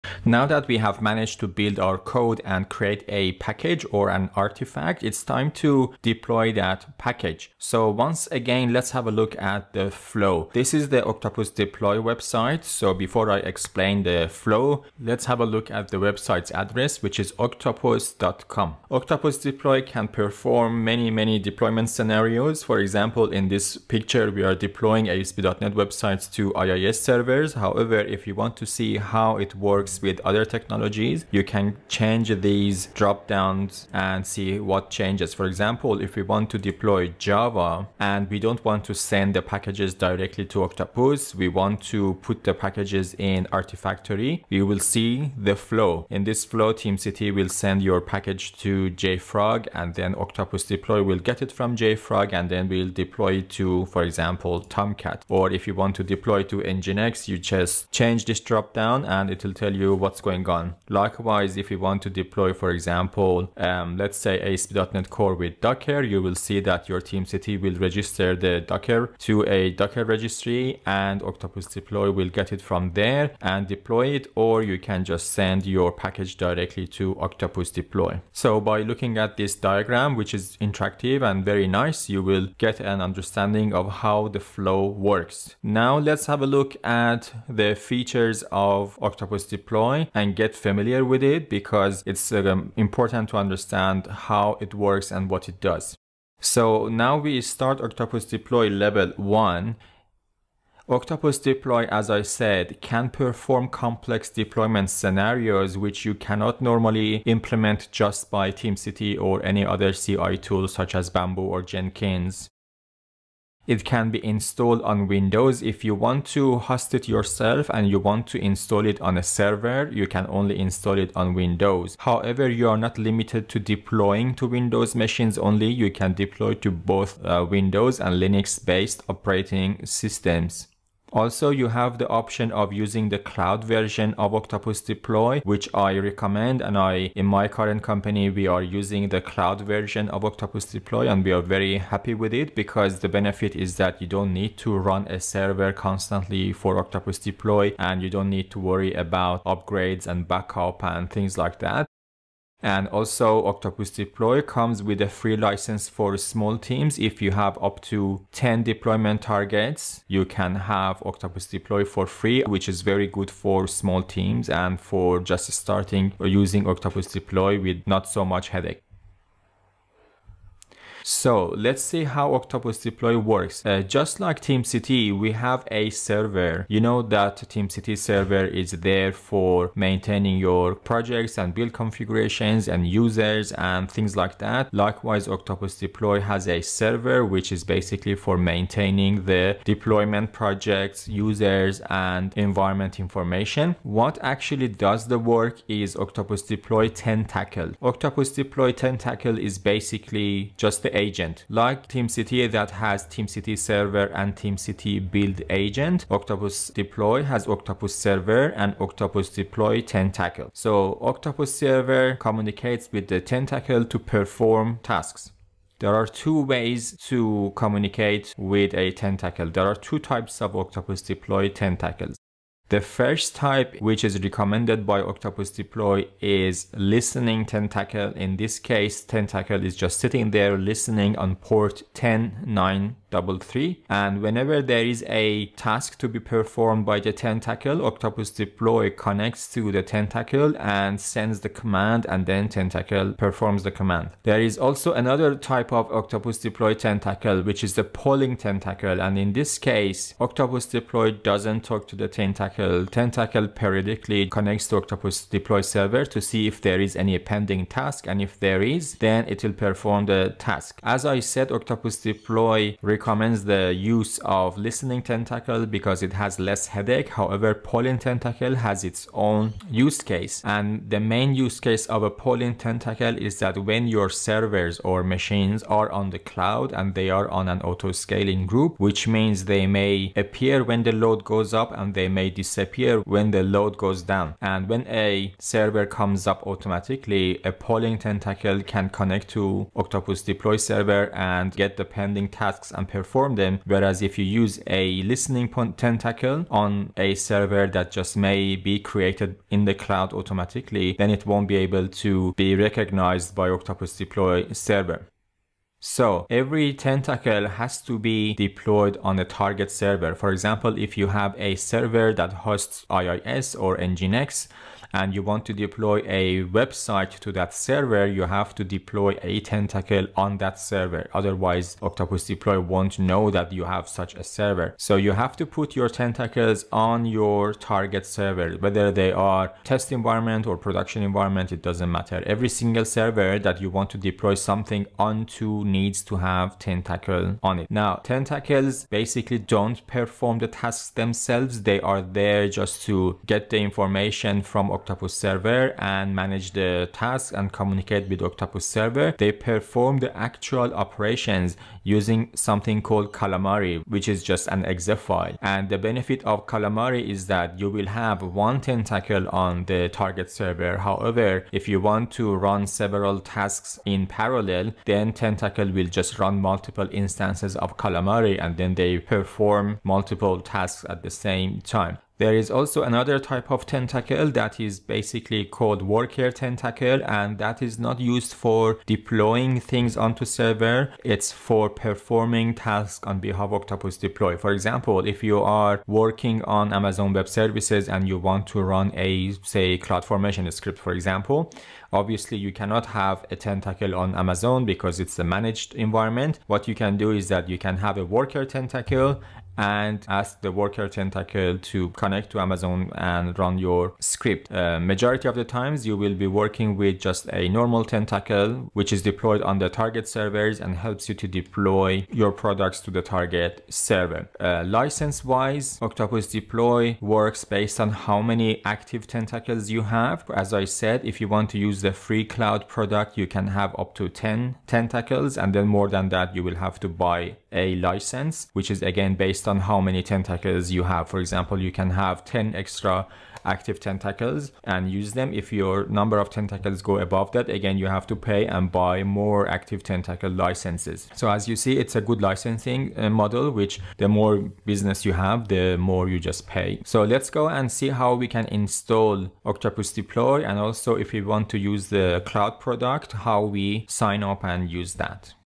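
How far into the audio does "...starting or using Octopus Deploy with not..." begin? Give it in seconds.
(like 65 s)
165 s.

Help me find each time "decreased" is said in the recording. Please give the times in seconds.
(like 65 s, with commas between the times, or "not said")
not said.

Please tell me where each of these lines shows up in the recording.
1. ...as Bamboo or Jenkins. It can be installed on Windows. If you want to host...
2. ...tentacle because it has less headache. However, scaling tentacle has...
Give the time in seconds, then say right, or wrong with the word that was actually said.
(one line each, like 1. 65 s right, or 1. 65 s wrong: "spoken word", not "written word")
1. 110 s right
2. 265 s wrong: "polling", not "scaling".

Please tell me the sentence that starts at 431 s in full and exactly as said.
For example, you can have 10 extra active tentacles and use them.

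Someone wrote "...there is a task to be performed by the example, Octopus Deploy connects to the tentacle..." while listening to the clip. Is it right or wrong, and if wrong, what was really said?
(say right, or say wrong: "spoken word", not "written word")
wrong: "tentacle", not "example".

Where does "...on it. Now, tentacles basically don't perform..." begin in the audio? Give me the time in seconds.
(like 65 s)
337 s.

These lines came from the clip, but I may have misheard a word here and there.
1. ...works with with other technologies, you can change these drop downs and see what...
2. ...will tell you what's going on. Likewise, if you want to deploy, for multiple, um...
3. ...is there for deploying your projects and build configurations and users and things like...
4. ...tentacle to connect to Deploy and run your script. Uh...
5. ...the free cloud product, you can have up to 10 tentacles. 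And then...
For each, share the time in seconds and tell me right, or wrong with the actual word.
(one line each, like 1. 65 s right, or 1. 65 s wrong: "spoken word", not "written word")
1. 29 s right
2. 59 s wrong: "example", not "multiple"
3. 178 s wrong: "maintaining", not "deploying"
4. 400 s wrong: "Amazon", not "Deploy"
5. 421 s right.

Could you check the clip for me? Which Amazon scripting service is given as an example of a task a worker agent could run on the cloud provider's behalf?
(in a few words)
CloudFormation.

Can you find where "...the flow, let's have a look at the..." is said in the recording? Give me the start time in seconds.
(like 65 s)
14 s.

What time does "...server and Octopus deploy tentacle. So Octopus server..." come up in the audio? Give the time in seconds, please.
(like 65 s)
207 s.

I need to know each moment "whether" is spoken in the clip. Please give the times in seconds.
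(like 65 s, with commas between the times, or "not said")
328 s.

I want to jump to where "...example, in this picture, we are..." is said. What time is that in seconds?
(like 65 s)
22 s.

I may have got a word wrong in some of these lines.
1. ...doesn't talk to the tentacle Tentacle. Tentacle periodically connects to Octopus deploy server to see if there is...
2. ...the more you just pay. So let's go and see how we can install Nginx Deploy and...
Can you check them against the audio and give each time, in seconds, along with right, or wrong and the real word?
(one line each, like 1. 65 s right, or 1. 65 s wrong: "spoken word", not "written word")
1. 251 s right
2. 445 s wrong: "Octopus", not "Nginx".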